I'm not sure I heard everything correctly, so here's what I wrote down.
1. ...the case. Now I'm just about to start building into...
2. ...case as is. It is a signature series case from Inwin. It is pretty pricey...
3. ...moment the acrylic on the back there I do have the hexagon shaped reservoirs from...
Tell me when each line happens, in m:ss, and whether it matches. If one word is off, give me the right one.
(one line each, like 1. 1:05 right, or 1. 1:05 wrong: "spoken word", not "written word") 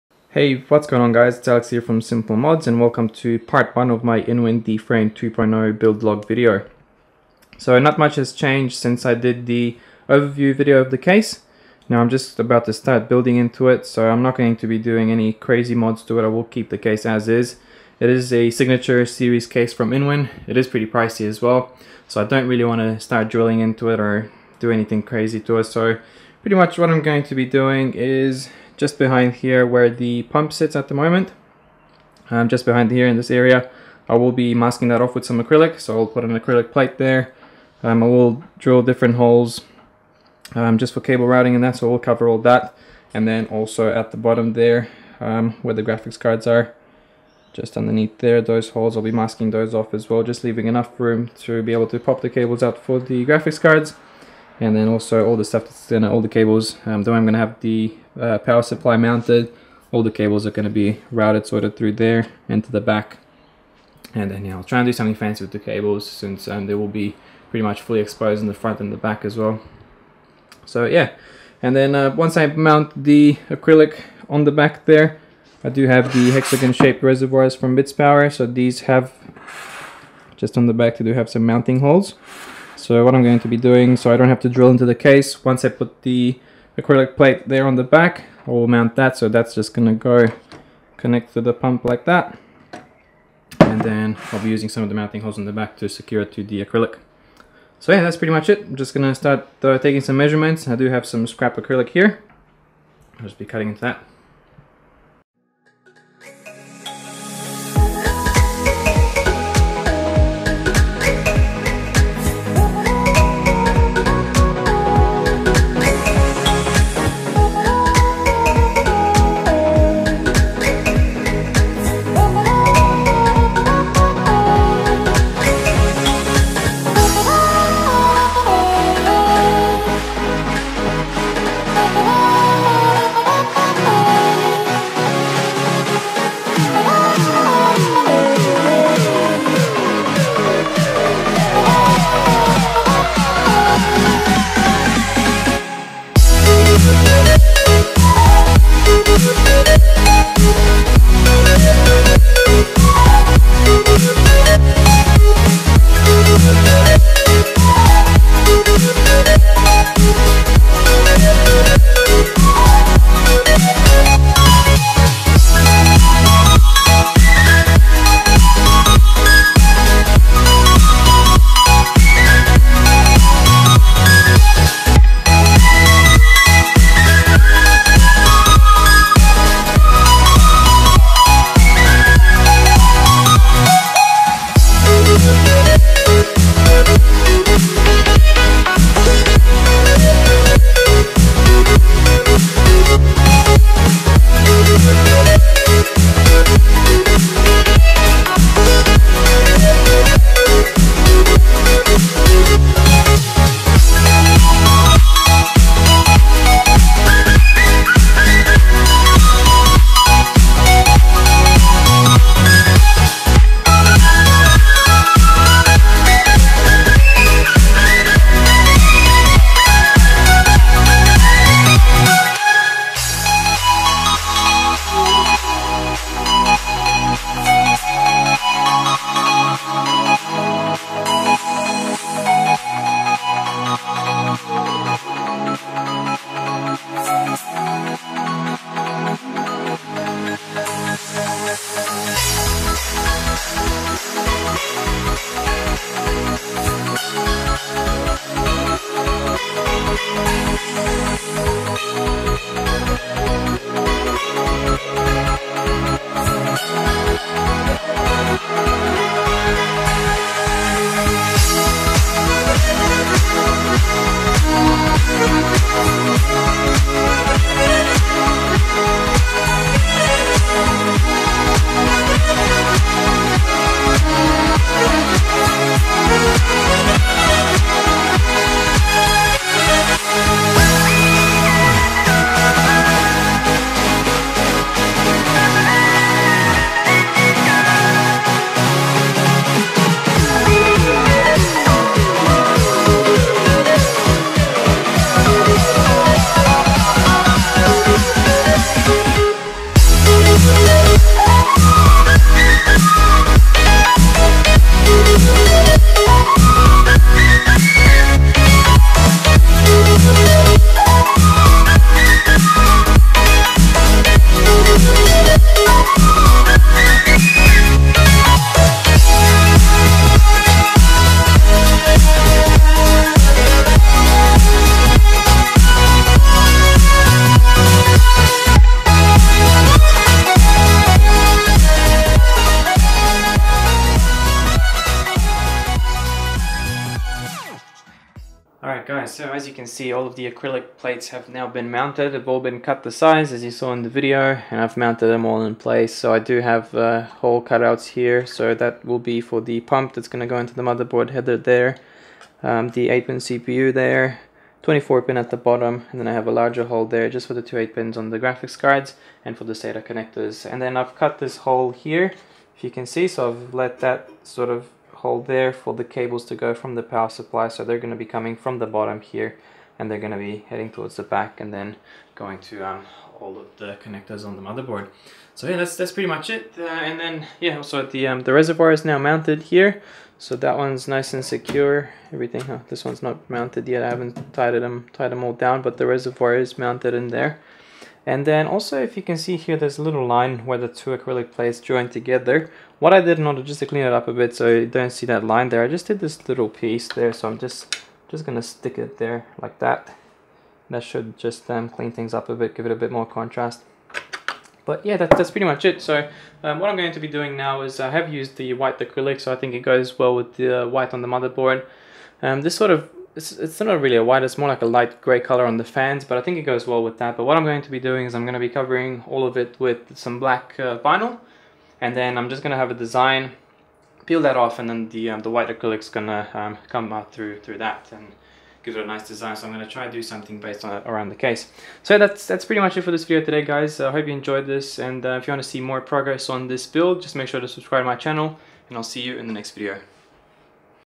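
1. 0:10 right
2. 0:16 right
3. 1:12 wrong: "mount", not "moment".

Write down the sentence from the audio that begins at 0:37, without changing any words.
Um, I will drill different holes um, just for cable routing and that.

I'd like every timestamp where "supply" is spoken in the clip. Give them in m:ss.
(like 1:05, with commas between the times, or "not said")
0:58, 6:07.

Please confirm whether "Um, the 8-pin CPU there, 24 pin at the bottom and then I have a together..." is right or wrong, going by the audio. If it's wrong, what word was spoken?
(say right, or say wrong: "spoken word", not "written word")
wrong: "larger", not "together".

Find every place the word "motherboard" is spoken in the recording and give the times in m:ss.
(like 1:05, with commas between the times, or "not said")
5:50, 6:14, 6:51.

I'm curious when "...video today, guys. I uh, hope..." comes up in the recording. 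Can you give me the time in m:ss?
7:13.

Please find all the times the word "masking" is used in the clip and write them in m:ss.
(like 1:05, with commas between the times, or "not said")
0:34, 0:49.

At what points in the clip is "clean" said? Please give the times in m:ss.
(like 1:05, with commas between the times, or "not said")
6:33, 6:41.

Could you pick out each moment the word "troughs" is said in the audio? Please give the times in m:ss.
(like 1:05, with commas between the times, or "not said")
not said.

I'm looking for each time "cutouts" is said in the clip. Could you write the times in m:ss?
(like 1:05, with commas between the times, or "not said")
5:47.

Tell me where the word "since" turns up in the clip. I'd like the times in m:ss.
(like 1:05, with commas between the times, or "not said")
0:08, 1:06.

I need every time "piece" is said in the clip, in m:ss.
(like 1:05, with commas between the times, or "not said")
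6:36.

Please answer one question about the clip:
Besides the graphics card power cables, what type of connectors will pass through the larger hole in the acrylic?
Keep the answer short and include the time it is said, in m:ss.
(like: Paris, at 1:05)
SATA connectors, at 5:59.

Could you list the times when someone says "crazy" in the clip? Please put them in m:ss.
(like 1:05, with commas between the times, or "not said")
0:15, 0:25.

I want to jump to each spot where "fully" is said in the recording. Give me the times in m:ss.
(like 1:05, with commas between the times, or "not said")
1:07.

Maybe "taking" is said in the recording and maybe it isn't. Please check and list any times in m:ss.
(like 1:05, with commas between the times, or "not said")
1:39.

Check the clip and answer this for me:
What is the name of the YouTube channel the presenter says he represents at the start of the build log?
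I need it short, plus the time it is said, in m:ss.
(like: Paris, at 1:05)
Simple Modz, at 0:02.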